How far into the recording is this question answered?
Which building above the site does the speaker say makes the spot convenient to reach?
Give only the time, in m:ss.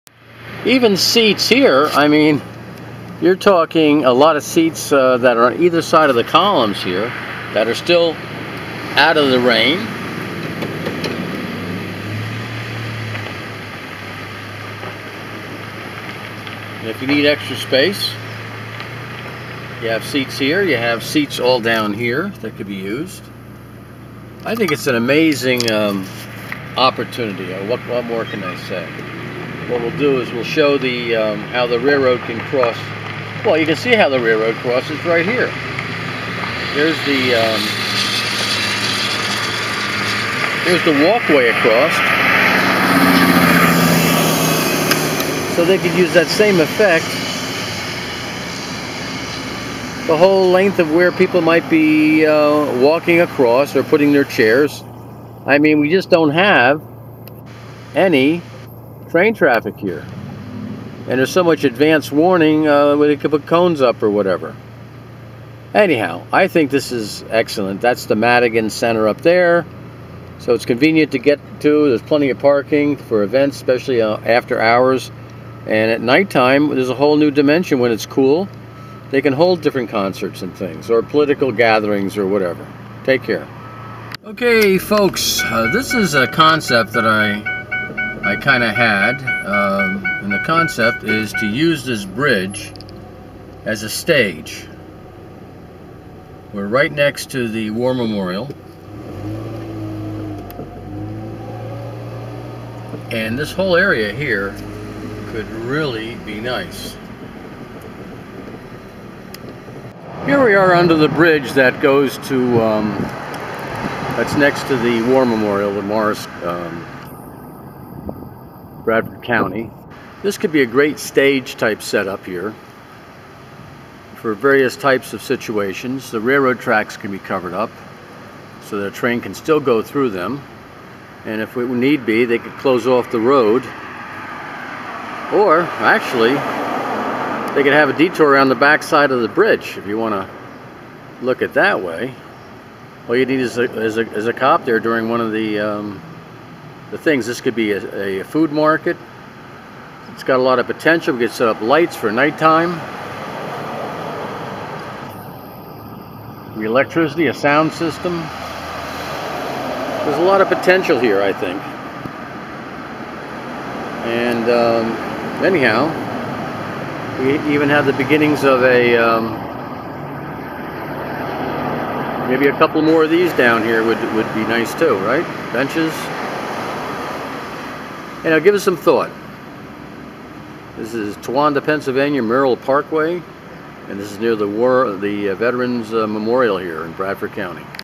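1:08.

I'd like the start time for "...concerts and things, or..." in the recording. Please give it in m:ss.
1:19.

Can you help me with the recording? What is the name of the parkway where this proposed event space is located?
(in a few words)
Merrill Parkway.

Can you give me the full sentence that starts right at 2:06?
The railroad tracks can be covered up so that a train can still go through them.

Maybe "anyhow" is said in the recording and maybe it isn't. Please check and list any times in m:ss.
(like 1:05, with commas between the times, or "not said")
1:05, 2:45.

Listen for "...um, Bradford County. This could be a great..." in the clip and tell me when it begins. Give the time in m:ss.
1:56.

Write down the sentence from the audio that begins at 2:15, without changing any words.
Or actually, they could have a detour around the backside of the bridge if you want to look at that way.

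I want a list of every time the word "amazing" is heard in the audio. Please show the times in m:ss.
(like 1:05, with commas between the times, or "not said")
0:24.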